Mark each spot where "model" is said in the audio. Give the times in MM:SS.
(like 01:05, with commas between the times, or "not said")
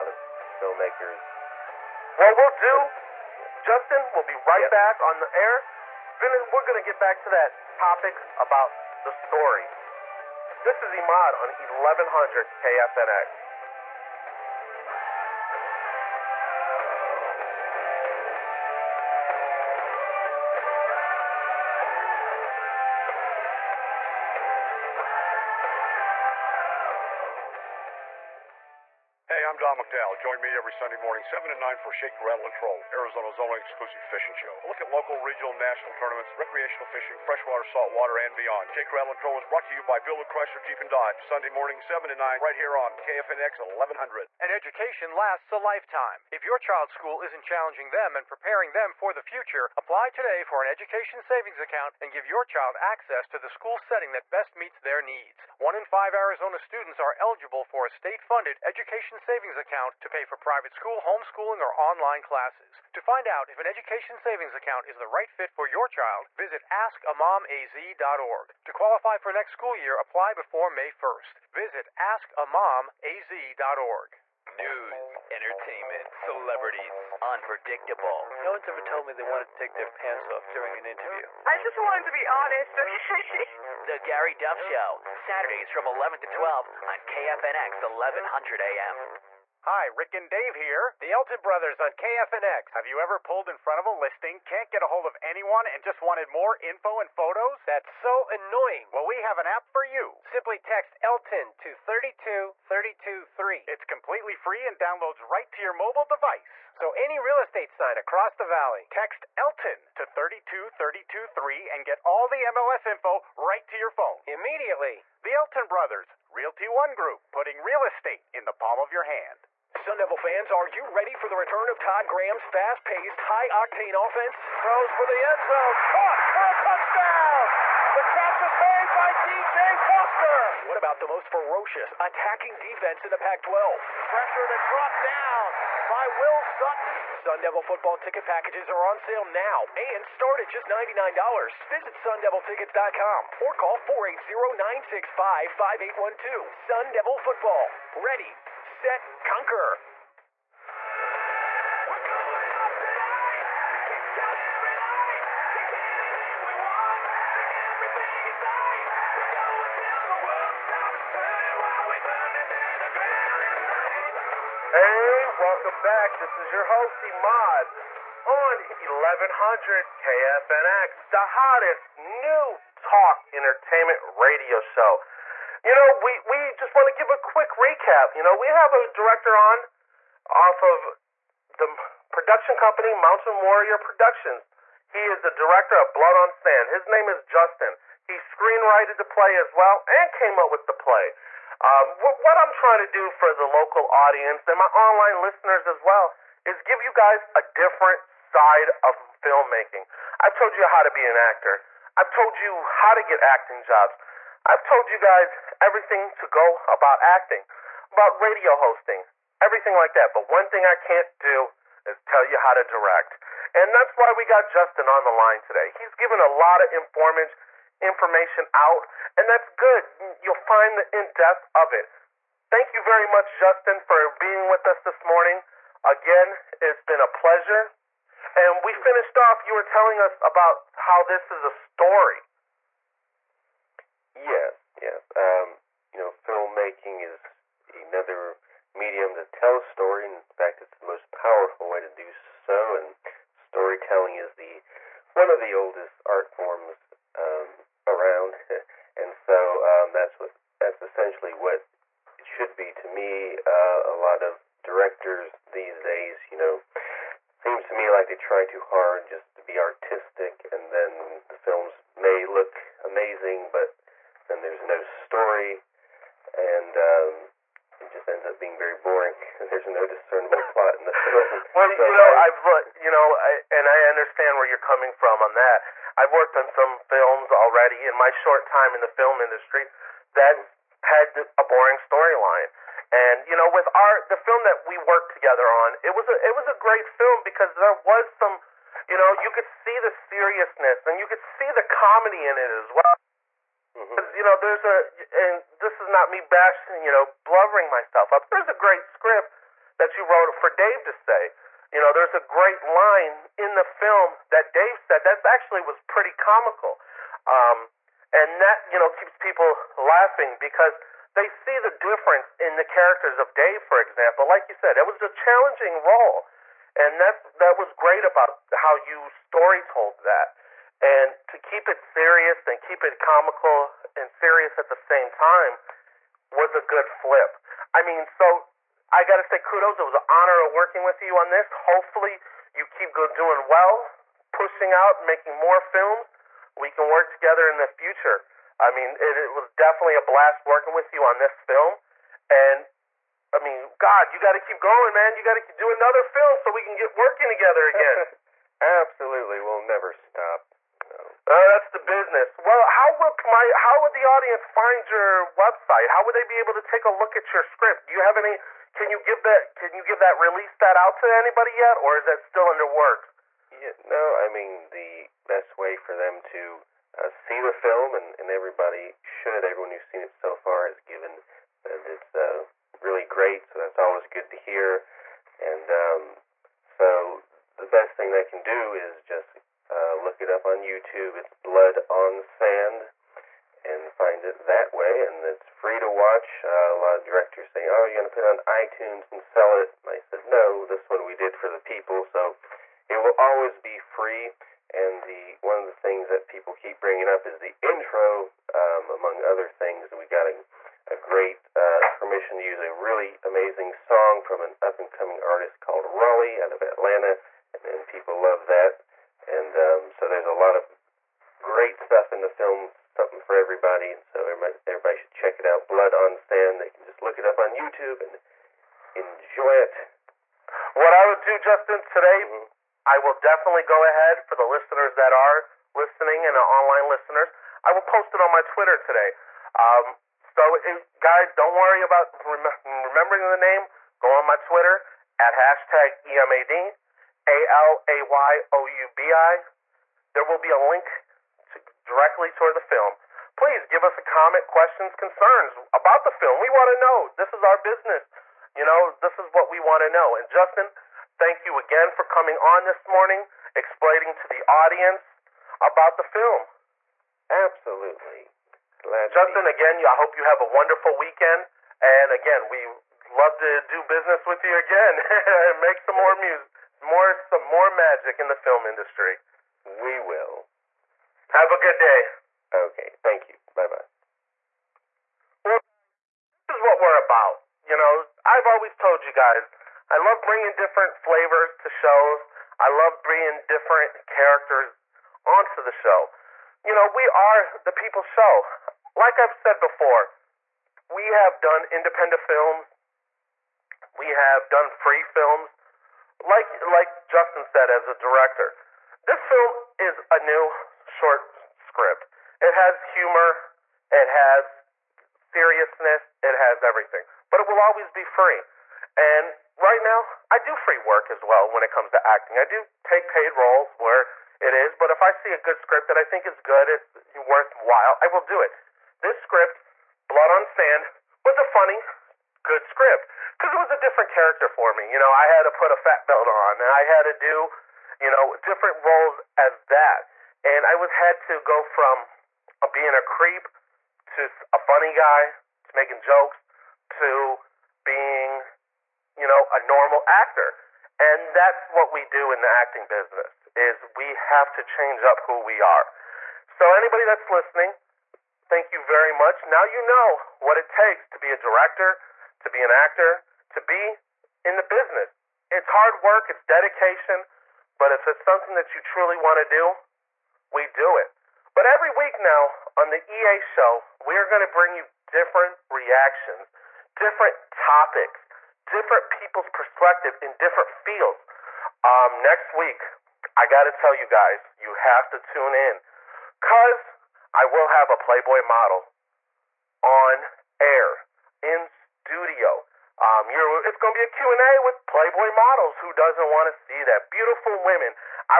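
09:38, 09:45.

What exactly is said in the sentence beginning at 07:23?
Please give us a comment, questions, concerns about the film.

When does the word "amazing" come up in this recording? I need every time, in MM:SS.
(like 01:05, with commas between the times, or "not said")
04:22, 06:43.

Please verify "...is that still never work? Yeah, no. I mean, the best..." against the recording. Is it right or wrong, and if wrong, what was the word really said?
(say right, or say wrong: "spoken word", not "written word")
wrong: "under", not "never".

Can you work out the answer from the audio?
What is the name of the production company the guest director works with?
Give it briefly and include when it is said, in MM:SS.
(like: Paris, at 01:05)
Mountain Warrior Productions, at 03:02.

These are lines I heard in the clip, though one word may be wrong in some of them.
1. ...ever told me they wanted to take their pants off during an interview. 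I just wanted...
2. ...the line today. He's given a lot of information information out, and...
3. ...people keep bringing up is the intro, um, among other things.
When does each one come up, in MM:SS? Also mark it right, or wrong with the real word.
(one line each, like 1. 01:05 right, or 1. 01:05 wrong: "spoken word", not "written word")
1. 01:18 right
2. 03:35 right
3. 06:36 right.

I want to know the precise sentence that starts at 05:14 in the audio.
Like you said, it was a challenging role.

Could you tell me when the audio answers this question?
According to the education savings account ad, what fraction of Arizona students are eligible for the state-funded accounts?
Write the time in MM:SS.
00:55.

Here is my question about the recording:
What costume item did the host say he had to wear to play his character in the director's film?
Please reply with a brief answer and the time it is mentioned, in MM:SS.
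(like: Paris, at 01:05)
fat belt, at 08:45.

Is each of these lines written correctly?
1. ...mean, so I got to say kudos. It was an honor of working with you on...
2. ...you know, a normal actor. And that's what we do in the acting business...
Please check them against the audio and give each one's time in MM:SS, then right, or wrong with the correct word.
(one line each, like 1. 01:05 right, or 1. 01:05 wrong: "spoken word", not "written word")
1. 05:27 right
2. 08:59 right.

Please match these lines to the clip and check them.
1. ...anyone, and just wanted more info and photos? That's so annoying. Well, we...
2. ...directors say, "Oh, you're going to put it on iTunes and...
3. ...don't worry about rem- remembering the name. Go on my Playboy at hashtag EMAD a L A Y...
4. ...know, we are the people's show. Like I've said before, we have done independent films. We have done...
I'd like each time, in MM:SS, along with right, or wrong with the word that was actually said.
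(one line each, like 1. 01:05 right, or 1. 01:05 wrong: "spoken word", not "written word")
1. 01:35 right
2. 06:27 right
3. 07:11 wrong: "Twitter", not "Playboy"
4. 08:06 right.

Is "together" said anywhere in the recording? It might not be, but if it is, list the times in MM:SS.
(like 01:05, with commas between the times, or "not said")
04:45, 05:37, 05:47.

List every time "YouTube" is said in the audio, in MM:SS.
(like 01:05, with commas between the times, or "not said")
06:20, 06:57.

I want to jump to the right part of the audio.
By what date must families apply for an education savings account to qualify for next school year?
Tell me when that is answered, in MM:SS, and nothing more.
01:10.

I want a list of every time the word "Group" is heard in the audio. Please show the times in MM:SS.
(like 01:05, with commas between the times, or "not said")
01:56.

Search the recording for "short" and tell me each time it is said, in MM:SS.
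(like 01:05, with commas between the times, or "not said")
04:38, 08:21.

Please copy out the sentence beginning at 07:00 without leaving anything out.
What I would do, Justin, today, mm-hmm.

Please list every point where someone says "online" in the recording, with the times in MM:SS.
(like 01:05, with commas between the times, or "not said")
01:01, 03:14, 07:06.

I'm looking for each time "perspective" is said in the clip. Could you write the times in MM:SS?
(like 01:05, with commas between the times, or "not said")
09:29.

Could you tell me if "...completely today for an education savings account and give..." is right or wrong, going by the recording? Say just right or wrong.
wrong.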